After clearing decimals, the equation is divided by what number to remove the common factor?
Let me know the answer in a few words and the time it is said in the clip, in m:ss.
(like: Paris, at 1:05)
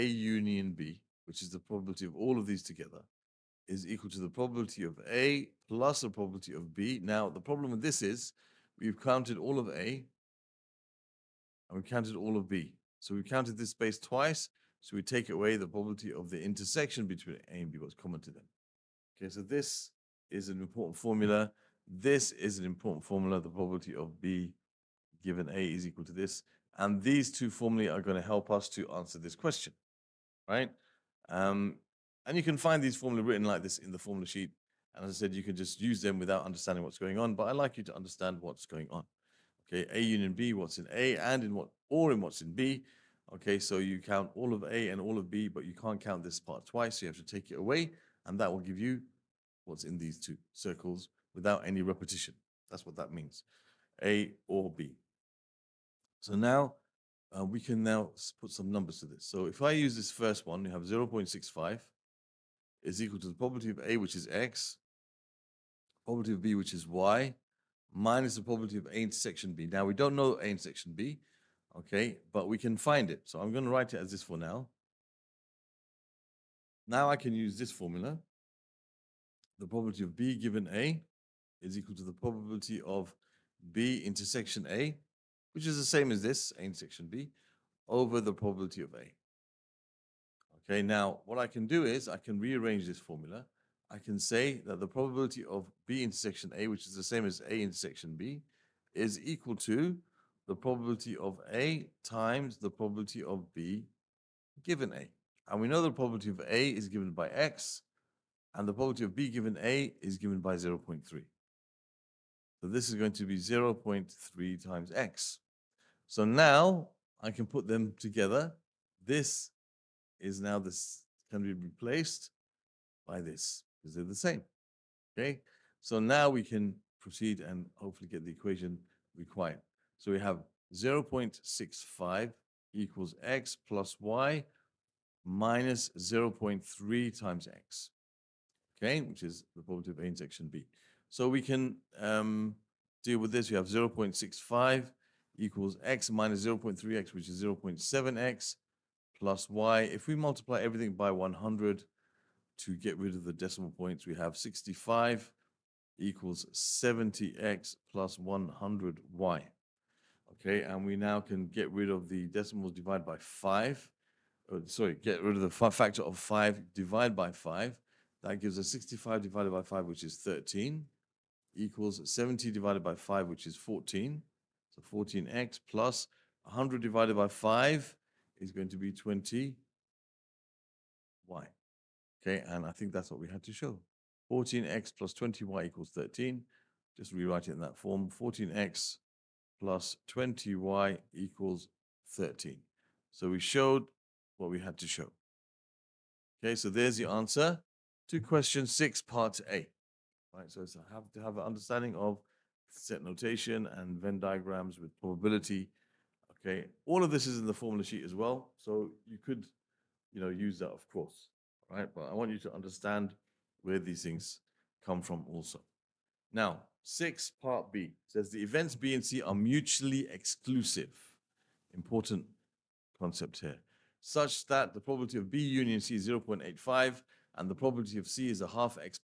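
5, at 2:46.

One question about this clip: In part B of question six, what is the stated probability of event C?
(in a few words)
1/2.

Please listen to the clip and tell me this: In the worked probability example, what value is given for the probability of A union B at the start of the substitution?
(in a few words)
0.65.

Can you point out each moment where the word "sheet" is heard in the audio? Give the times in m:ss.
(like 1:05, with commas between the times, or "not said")
0:34, 3:27.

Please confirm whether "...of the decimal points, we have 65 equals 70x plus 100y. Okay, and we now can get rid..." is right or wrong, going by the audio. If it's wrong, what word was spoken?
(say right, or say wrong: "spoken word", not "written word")
right.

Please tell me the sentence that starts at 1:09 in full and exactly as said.
Now, we don't know A intersection B, okay, but we can find it.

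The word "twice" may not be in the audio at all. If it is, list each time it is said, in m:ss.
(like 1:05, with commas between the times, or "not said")
0:13, 0:46.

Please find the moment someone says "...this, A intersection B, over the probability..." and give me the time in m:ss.
1:26.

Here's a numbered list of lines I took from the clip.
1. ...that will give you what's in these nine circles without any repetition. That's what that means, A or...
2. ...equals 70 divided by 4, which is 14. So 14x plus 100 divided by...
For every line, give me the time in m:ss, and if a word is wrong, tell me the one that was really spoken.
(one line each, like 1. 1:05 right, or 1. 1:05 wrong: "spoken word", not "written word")
1. 0:48 wrong: "two", not "nine"
2. 2:51 wrong: "5", not "4".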